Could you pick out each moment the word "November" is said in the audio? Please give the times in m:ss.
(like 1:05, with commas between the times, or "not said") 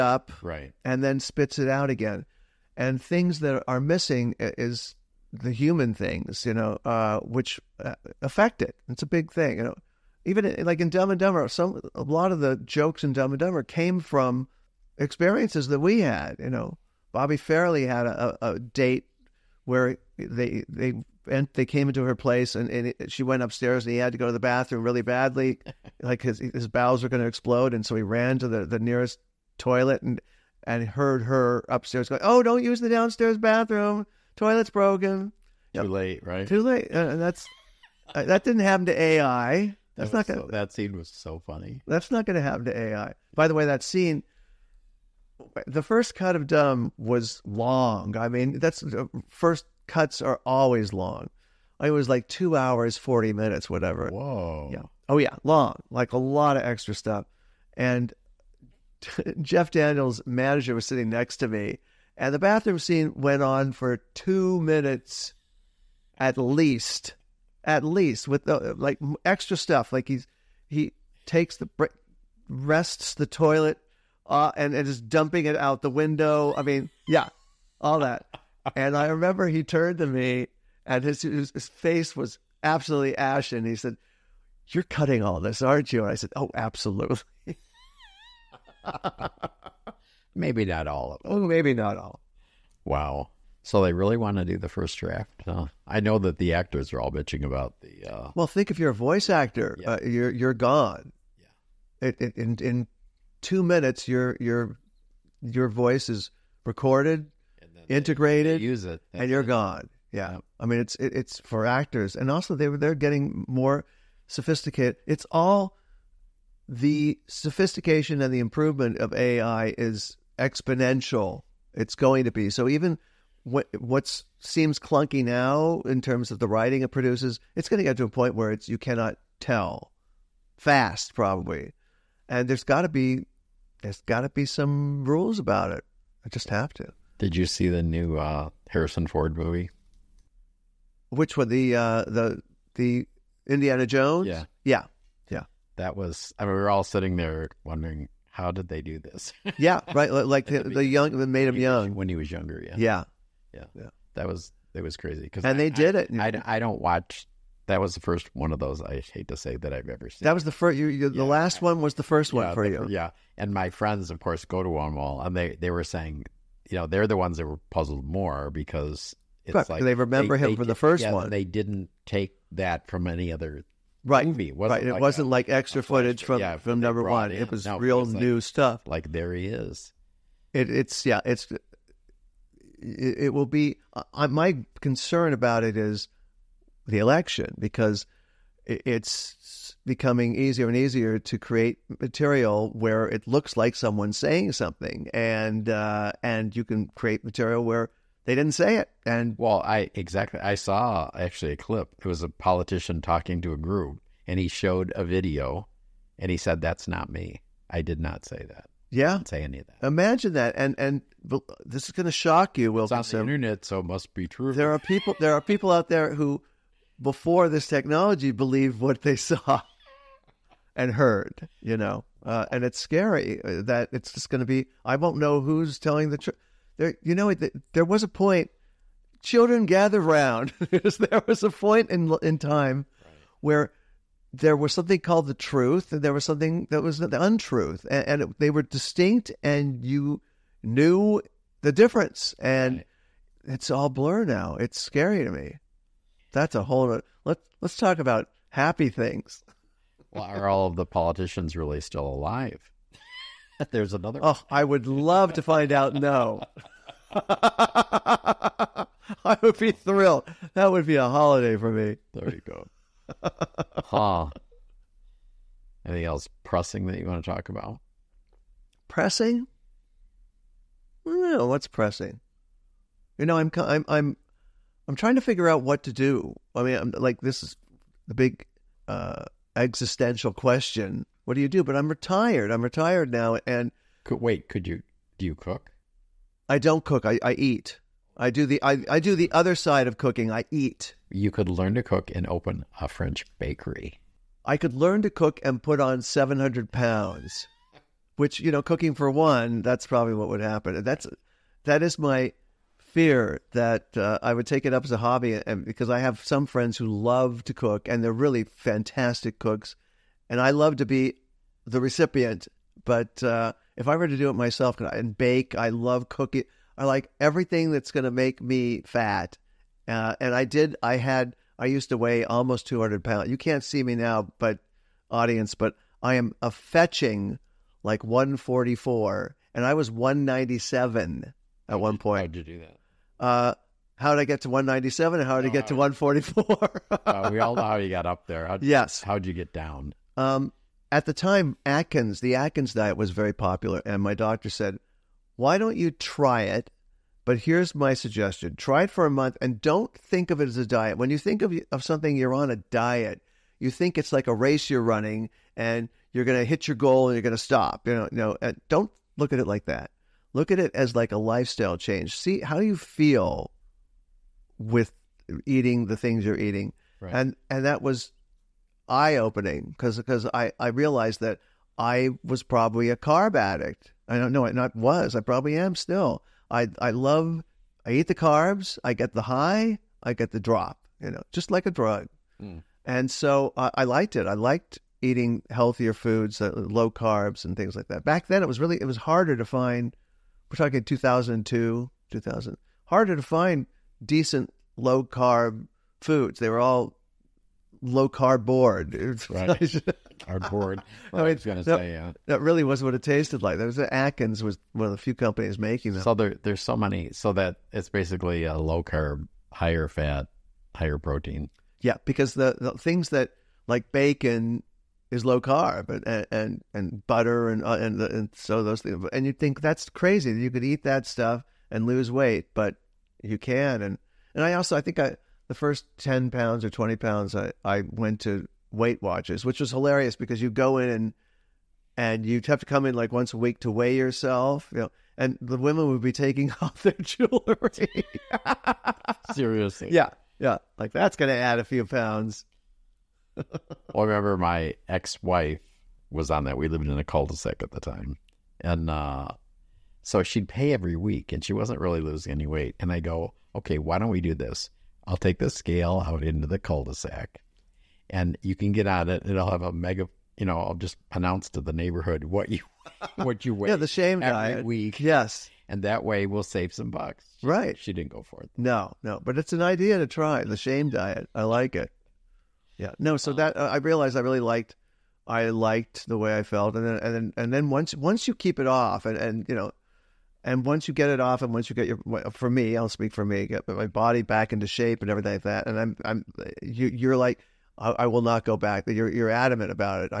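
not said.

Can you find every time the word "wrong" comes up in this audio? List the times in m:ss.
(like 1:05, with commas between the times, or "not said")
not said.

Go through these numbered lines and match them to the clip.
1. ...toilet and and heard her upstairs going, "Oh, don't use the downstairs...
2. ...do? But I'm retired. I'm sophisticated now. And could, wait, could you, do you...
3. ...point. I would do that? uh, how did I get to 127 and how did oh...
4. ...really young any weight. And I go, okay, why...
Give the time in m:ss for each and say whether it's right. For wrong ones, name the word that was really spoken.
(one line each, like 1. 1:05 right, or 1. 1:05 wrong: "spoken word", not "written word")
1. 0:29 right
2. 4:41 wrong: "retired", not "sophisticated"
3. 5:31 wrong: "197", not "127"
4. 7:31 wrong: "losing", not "young".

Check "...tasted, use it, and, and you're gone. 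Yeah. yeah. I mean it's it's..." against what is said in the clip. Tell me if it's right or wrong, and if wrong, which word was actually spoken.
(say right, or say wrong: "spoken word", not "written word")
wrong: "integrated", not "tasted".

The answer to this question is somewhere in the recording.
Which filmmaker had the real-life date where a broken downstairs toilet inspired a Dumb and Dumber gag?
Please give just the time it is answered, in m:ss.
0:17.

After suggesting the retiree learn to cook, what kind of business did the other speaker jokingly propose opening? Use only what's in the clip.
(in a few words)
French bakery.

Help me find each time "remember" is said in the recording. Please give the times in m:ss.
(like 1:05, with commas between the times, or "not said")
1:19, 2:49, 7:24.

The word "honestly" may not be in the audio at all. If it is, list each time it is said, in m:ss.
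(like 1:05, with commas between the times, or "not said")
not said.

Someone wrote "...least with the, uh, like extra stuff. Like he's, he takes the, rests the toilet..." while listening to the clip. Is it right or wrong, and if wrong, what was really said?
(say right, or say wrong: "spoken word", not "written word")
right.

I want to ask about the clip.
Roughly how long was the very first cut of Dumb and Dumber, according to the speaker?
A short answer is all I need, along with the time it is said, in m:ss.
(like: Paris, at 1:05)
2 hours 40 minutes, at 0:52.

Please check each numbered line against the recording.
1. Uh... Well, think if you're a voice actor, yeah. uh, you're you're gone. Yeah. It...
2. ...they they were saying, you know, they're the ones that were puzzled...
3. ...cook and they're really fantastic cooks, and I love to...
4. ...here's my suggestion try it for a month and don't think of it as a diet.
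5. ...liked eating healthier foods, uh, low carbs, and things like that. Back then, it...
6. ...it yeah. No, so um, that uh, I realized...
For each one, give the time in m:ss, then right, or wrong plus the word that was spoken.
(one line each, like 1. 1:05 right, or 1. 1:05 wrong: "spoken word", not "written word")
1. 1:38 right
2. 2:45 right
3. 5:07 right
4. 5:47 right
5. 6:24 right
6. 7:51 right.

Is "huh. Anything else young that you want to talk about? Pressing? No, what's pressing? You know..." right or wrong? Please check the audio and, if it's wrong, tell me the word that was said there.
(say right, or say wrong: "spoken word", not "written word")
wrong: "pressing", not "young".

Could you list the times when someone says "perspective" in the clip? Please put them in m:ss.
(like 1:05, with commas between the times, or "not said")
not said.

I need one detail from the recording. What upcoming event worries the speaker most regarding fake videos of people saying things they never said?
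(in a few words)
The election.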